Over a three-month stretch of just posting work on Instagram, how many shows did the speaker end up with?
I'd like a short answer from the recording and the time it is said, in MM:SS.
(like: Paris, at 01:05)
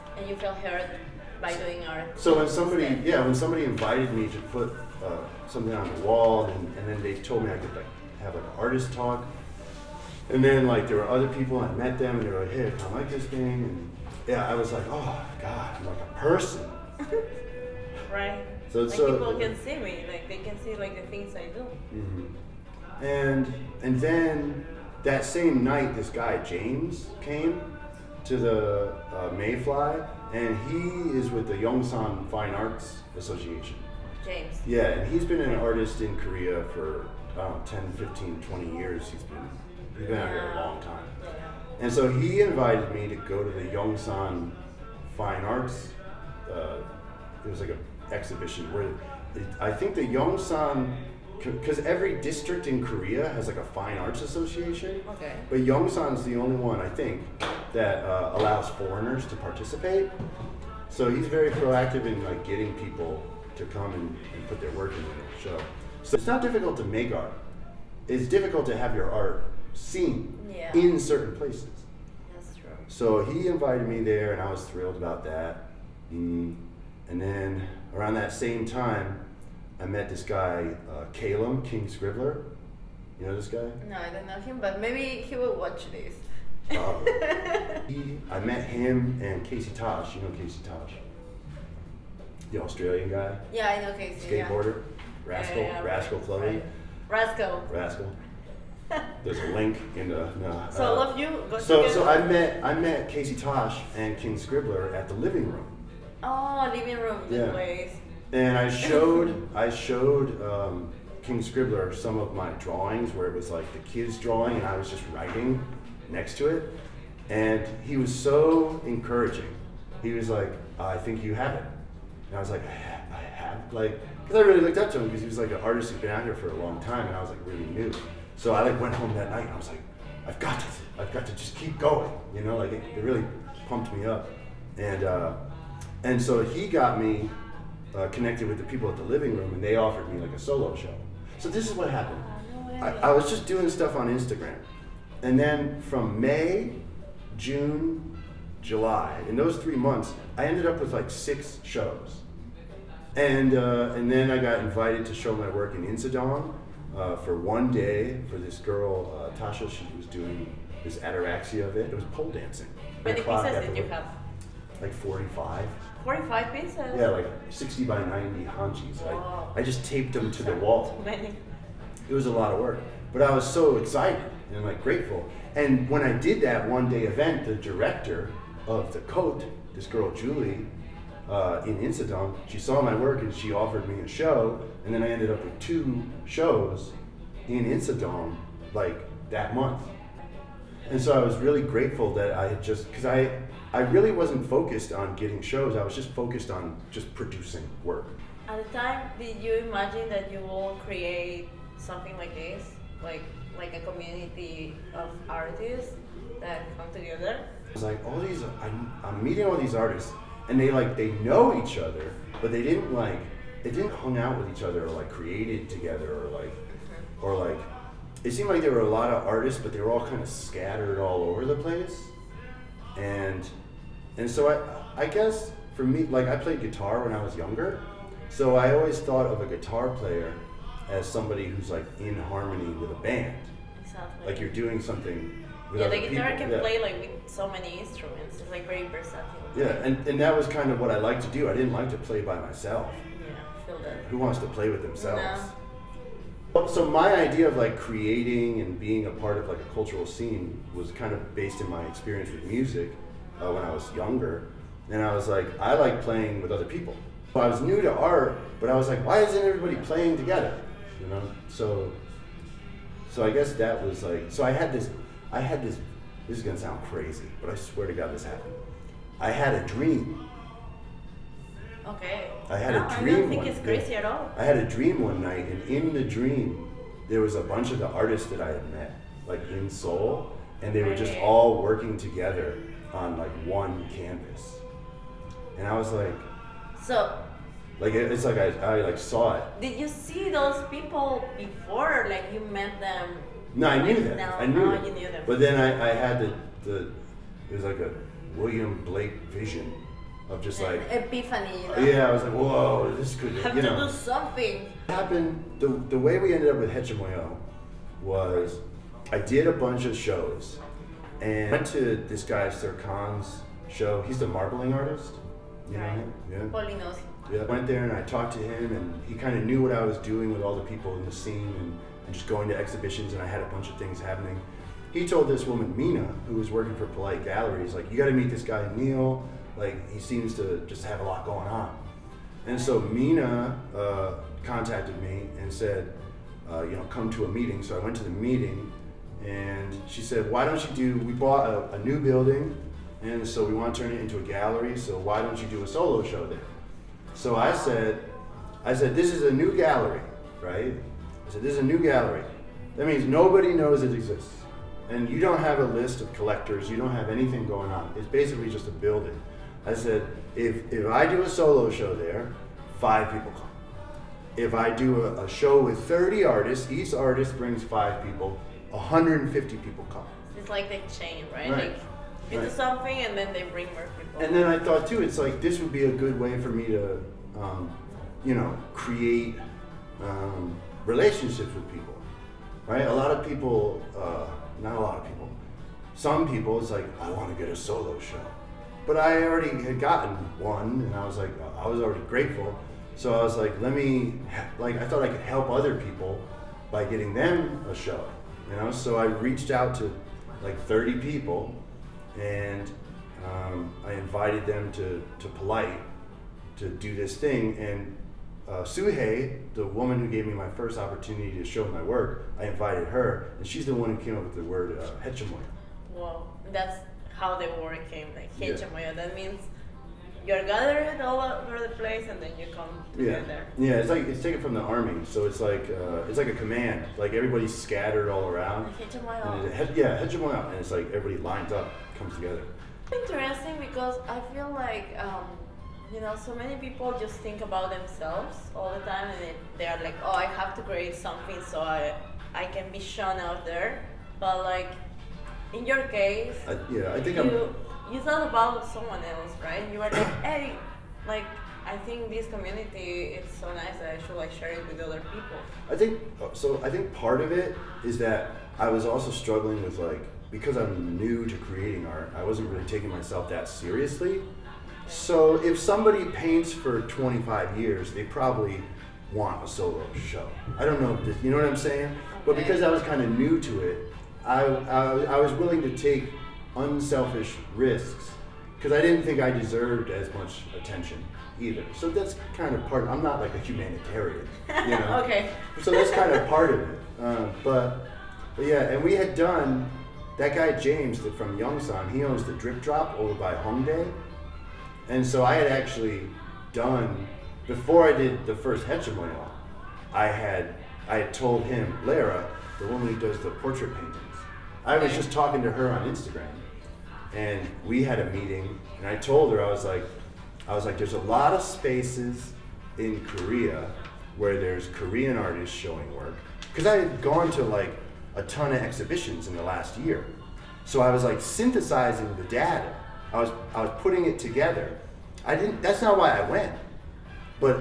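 6, at 02:31.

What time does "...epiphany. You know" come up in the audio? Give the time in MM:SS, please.
05:00.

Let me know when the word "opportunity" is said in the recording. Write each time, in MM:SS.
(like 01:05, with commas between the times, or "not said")
06:50.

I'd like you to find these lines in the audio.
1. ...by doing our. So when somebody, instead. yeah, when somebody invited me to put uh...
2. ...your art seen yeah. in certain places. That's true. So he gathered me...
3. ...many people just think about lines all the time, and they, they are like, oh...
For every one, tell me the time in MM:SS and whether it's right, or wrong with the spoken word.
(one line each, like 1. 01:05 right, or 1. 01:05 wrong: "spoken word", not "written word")
1. 00:01 right
2. 01:08 wrong: "invited", not "gathered"
3. 07:16 wrong: "themselves", not "lines".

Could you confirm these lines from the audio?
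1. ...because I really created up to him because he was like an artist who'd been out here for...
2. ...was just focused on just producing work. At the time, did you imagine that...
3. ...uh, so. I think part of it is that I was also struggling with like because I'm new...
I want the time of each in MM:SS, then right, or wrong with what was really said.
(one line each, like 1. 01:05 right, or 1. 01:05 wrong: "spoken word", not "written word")
1. 02:04 wrong: "looked", not "created"
2. 03:15 right
3. 07:36 right.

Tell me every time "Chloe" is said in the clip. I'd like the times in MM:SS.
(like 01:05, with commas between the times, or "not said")
01:36.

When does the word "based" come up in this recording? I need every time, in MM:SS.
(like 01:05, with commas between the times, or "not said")
04:11.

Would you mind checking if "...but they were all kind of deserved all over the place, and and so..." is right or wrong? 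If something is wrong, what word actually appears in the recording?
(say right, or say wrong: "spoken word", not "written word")
wrong: "scattered", not "deserved".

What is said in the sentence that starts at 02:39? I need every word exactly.
She was doing this ataraxia of it.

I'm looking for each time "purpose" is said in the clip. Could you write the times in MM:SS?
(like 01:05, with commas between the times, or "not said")
not said.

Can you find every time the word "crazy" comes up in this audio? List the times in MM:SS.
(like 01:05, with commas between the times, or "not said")
04:26, 04:33.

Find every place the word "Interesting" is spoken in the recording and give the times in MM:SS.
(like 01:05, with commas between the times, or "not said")
07:12.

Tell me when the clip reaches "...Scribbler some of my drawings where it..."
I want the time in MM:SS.
01:51.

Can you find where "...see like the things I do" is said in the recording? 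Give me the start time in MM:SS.
00:20.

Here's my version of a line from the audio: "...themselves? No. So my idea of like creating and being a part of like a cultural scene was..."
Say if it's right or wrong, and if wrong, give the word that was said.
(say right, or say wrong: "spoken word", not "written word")
right.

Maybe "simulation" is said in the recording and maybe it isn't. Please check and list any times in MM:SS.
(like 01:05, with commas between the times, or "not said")
not said.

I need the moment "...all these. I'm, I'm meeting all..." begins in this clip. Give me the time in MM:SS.
03:28.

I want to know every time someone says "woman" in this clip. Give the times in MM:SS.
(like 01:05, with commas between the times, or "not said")
05:25, 06:49, 08:22.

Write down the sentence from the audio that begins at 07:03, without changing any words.
Yeah, yeah it's like it's taken from the army, so it's like uh, it's like a command.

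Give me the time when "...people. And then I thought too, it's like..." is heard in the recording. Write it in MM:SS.
06:13.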